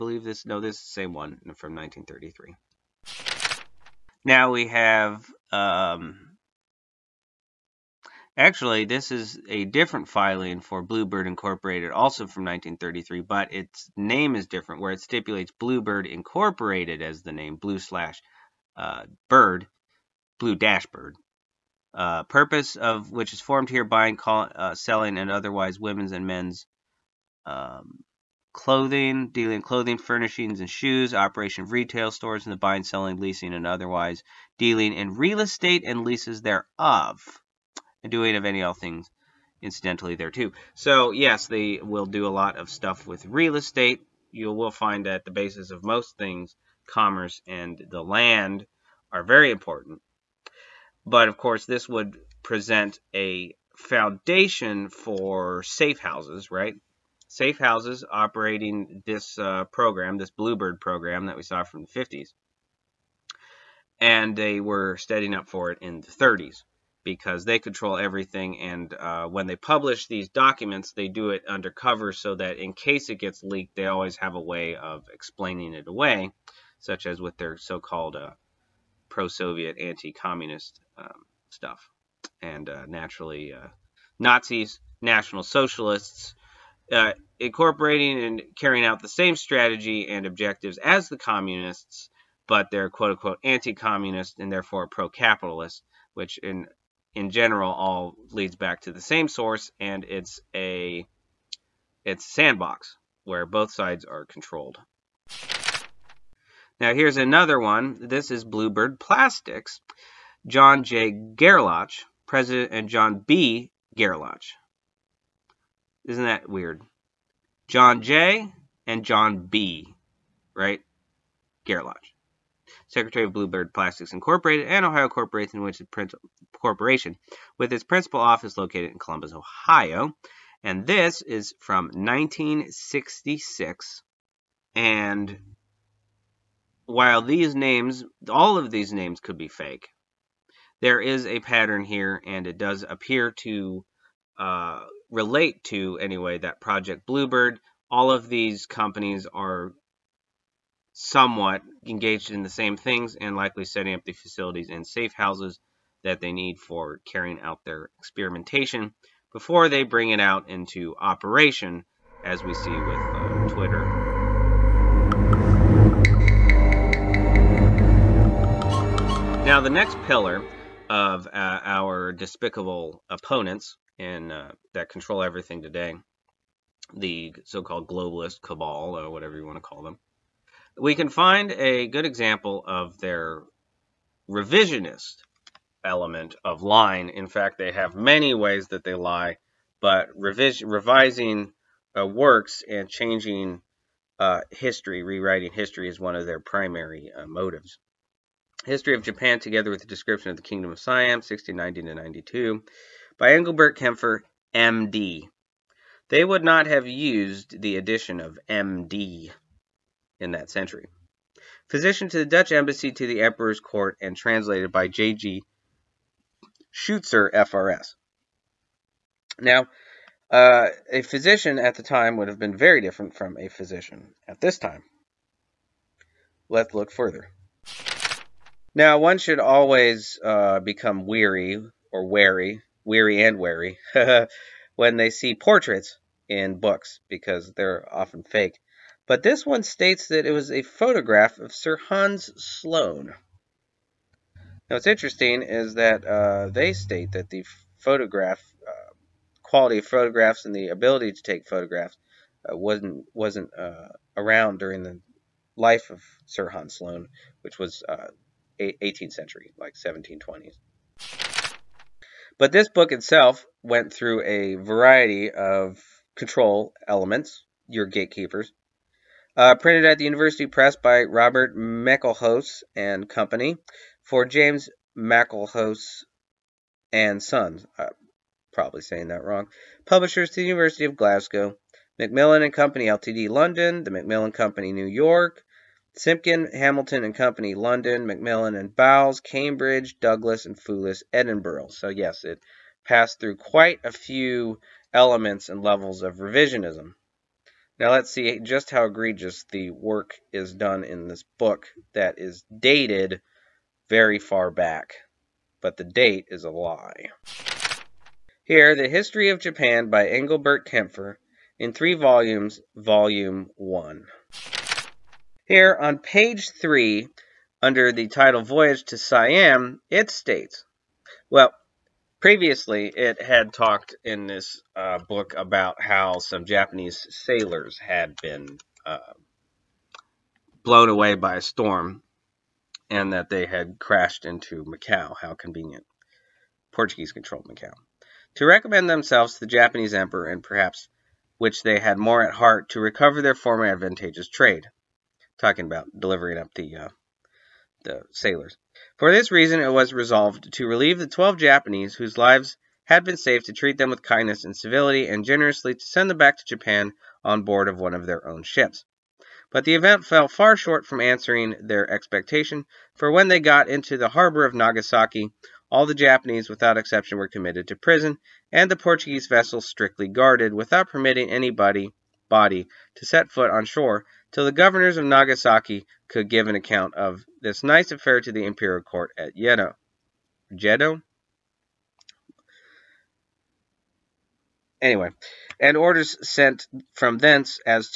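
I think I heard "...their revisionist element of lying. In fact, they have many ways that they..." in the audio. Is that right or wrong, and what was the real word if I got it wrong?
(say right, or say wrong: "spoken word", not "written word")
right.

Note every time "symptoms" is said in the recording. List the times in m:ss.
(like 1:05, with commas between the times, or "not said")
not said.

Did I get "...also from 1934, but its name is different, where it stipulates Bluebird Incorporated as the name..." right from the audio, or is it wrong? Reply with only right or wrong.
wrong.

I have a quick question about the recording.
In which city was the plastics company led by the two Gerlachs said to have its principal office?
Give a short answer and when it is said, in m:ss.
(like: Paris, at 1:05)
Columbus, Ohio, at 2:08.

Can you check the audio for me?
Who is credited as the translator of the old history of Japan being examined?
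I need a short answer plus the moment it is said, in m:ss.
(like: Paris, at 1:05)
J.G. Scheuchzer, at 3:34.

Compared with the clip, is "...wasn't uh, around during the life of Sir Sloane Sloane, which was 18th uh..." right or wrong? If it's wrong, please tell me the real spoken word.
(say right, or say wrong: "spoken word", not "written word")
wrong: "Hans", not "Sloane".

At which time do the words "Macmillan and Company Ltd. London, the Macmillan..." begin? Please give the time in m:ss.
4:41.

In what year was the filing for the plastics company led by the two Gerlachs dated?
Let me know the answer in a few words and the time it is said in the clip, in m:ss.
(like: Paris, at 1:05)
1966, at 2:11.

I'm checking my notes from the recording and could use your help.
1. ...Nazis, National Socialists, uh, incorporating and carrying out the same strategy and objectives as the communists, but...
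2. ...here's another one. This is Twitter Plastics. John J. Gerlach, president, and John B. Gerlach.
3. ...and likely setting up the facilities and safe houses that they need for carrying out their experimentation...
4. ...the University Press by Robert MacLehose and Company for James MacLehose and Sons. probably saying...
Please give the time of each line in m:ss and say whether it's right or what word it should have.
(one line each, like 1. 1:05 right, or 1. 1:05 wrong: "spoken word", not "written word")
1. 1:24 right
2. 1:46 wrong: "Bluebird", not "Twitter"
3. 2:33 right
4. 4:29 right.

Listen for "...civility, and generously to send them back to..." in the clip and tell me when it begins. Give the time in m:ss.
5:54.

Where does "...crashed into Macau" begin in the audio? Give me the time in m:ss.
5:33.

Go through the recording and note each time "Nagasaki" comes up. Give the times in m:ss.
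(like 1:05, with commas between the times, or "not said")
6:04, 6:15.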